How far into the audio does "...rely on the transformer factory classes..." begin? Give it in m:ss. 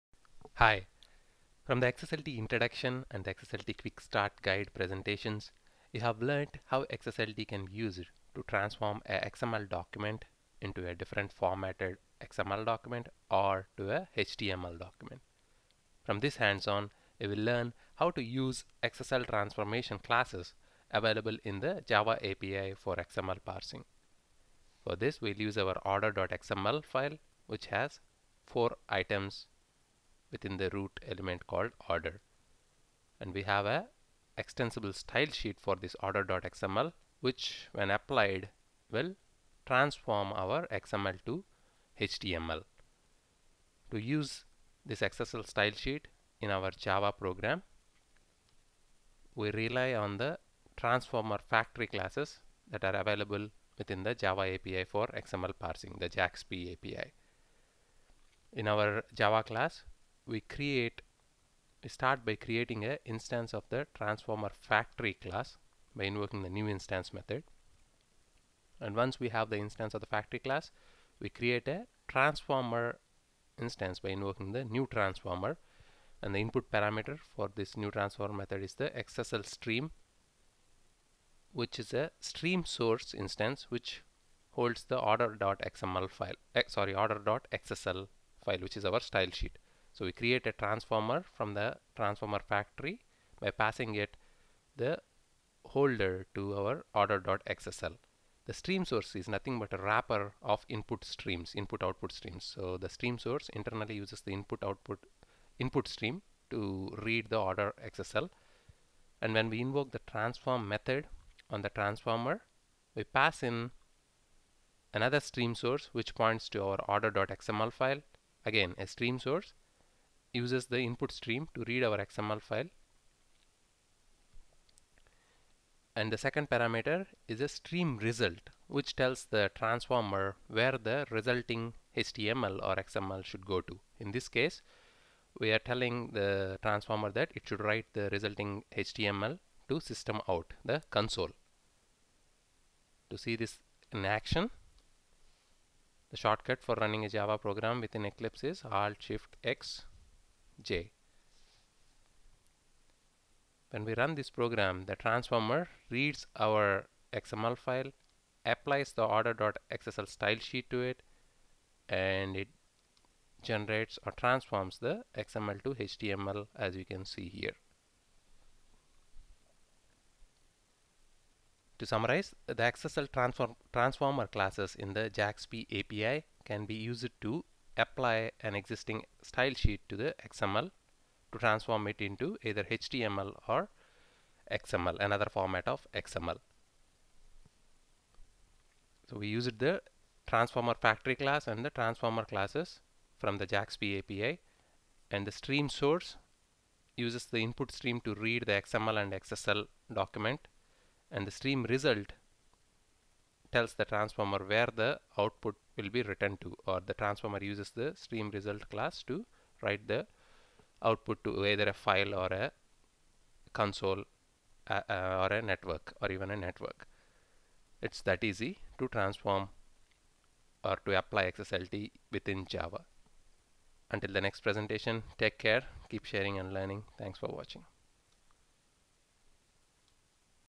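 0:49.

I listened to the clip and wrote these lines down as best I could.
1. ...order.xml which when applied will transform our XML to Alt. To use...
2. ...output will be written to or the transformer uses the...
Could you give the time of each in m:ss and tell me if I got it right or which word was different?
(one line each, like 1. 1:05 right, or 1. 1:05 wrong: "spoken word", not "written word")
1. 0:36 wrong: "HTML", not "Alt"
2. 3:25 right.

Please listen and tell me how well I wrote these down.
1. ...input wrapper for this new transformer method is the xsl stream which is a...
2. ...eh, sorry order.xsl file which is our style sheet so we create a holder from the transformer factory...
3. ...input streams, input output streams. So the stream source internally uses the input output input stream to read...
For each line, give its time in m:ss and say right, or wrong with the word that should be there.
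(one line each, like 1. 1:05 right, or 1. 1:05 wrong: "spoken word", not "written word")
1. 1:16 wrong: "parameter", not "wrapper"
2. 1:26 wrong: "transformer", not "holder"
3. 1:40 right.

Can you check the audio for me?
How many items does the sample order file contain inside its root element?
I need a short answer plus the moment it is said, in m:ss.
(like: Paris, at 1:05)
4, at 0:28.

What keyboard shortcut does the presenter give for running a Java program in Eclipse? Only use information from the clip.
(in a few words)
Alt Shift X J.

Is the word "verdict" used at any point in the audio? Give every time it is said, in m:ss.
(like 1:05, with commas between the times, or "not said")
not said.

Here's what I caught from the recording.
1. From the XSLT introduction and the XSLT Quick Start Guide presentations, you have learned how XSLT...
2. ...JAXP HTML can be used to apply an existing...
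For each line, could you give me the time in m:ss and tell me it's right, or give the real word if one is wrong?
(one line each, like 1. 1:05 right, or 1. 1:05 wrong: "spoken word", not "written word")
1. 0:01 right
2. 2:55 wrong: "API", not "HTML".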